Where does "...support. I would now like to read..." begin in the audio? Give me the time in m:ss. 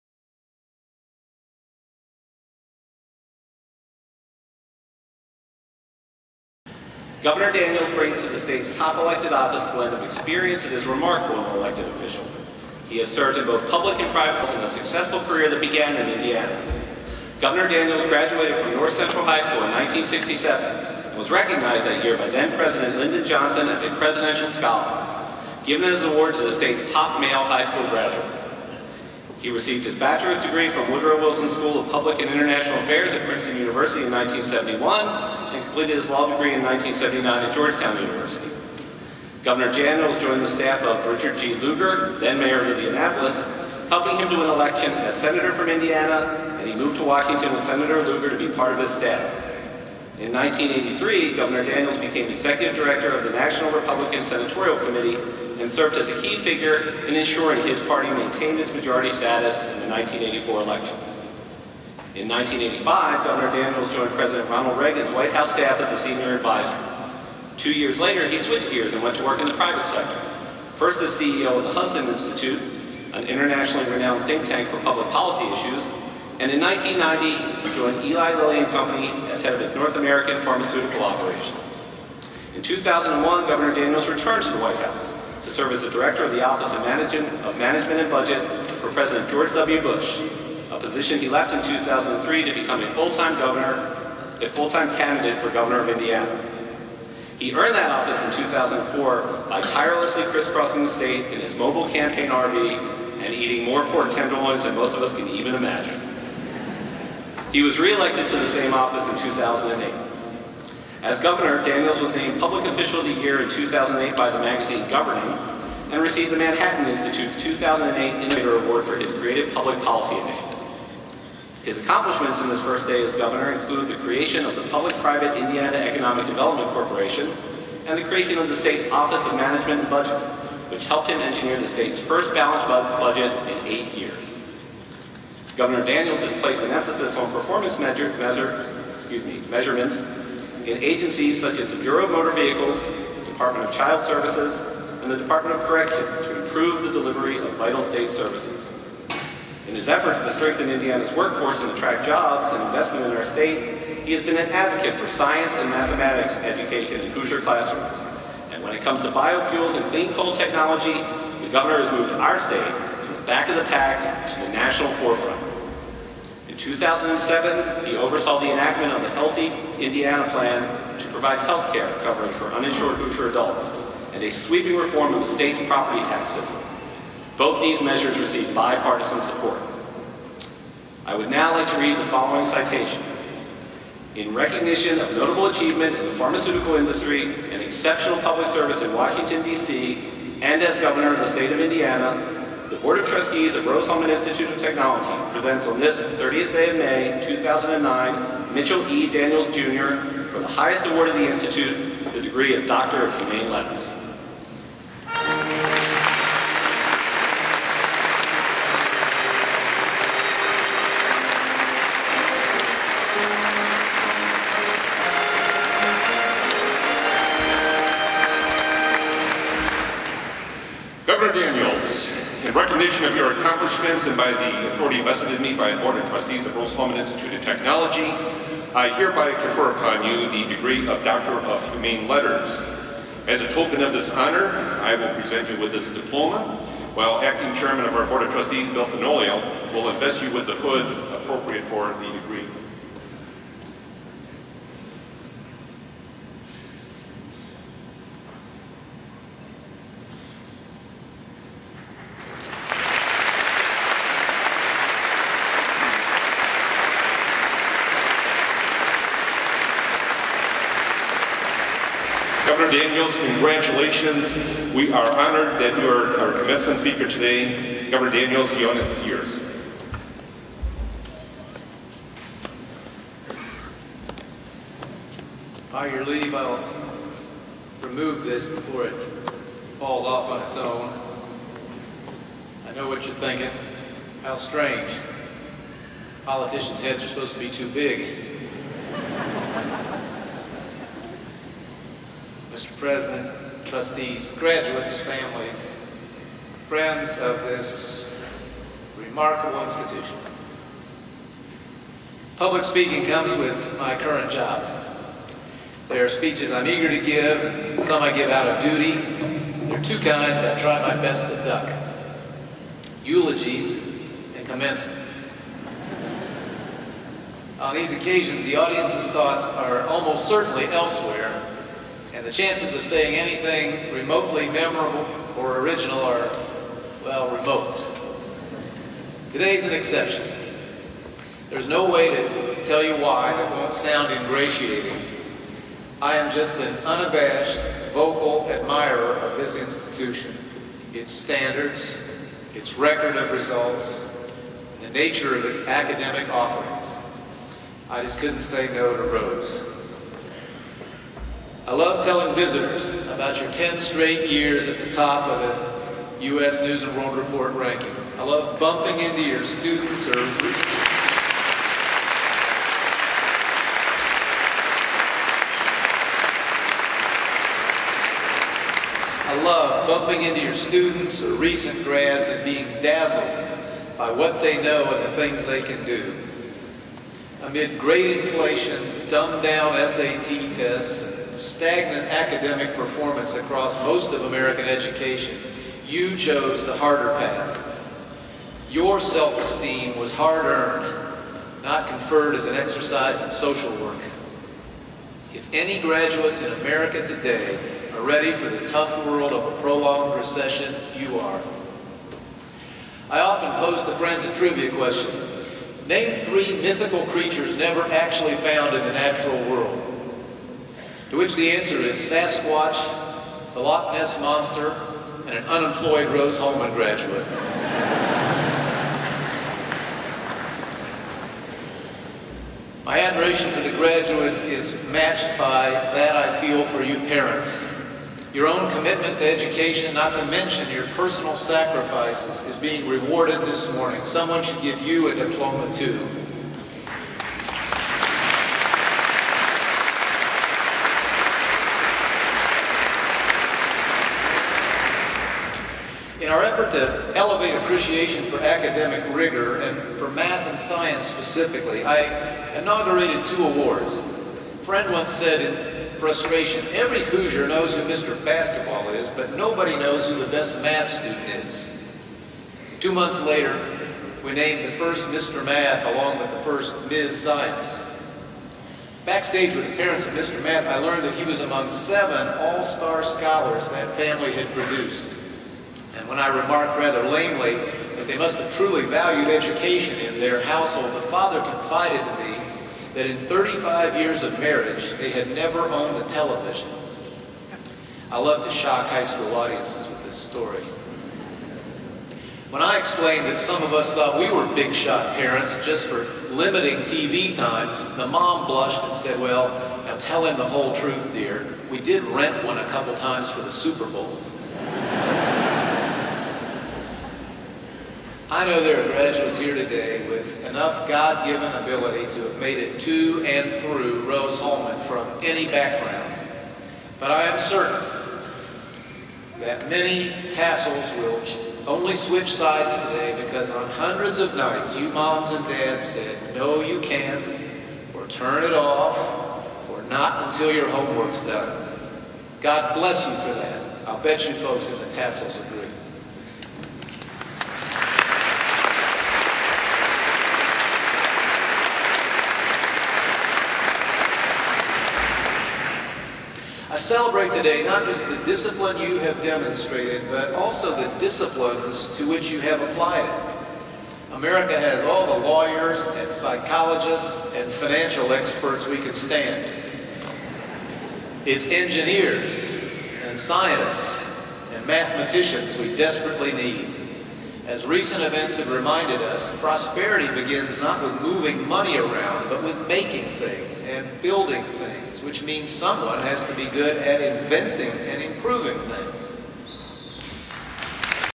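2:59.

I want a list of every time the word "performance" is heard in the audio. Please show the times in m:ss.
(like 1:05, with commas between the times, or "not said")
2:17, 6:22.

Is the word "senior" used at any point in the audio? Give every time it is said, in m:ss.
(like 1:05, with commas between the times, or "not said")
1:05.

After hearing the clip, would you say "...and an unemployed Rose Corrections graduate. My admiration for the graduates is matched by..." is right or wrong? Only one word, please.
wrong.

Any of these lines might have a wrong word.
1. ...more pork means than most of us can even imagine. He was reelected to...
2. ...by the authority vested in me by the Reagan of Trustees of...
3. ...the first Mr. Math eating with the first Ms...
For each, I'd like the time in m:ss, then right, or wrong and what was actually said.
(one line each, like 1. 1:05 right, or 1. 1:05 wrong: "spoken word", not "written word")
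1. 1:43 wrong: "tenderloins", not "means"
2. 3:44 wrong: "Board", not "Reagan"
3. 7:44 wrong: "along", not "eating".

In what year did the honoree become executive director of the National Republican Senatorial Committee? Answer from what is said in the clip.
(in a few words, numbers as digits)
1983.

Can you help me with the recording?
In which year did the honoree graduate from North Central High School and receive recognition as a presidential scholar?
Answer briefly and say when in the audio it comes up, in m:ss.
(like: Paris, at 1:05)
1967, at 0:19.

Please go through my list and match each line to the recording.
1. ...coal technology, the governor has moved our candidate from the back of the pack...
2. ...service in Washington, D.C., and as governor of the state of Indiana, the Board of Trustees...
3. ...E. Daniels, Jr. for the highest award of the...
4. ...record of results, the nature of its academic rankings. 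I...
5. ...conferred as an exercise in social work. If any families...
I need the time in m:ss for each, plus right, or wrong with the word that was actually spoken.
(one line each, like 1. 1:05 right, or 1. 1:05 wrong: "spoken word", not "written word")
1. 2:40 wrong: "state", not "candidate"
2. 3:08 right
3. 3:18 right
4. 5:42 wrong: "offerings", not "rankings"
5. 6:31 wrong: "graduates", not "families".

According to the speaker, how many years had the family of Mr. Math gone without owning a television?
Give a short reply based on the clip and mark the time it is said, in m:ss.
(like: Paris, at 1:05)
35, at 8:03.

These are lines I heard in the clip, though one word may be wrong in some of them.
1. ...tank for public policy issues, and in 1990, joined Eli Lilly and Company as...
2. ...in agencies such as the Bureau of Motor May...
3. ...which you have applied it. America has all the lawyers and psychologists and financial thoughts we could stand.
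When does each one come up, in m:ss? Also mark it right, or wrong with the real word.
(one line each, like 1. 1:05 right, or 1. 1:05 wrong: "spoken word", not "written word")
1. 1:14 right
2. 2:20 wrong: "Vehicles", not "May"
3. 9:12 wrong: "experts", not "thoughts".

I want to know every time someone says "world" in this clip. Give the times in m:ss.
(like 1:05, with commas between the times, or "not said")
5:56, 6:39, 6:49.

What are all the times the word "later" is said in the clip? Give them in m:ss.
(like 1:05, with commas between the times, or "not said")
1:08, 7:43.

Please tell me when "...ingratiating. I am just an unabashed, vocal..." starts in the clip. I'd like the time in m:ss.
5:34.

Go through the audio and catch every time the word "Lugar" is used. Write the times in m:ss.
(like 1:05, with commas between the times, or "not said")
0:41, 0:48.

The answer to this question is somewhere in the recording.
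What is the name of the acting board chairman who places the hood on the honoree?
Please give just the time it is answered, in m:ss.
3:58.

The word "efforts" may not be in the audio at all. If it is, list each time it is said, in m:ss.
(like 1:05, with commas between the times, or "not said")
2:29, 7:26.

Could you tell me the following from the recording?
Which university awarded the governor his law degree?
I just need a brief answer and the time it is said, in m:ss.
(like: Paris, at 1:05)
Georgetown University, at 0:37.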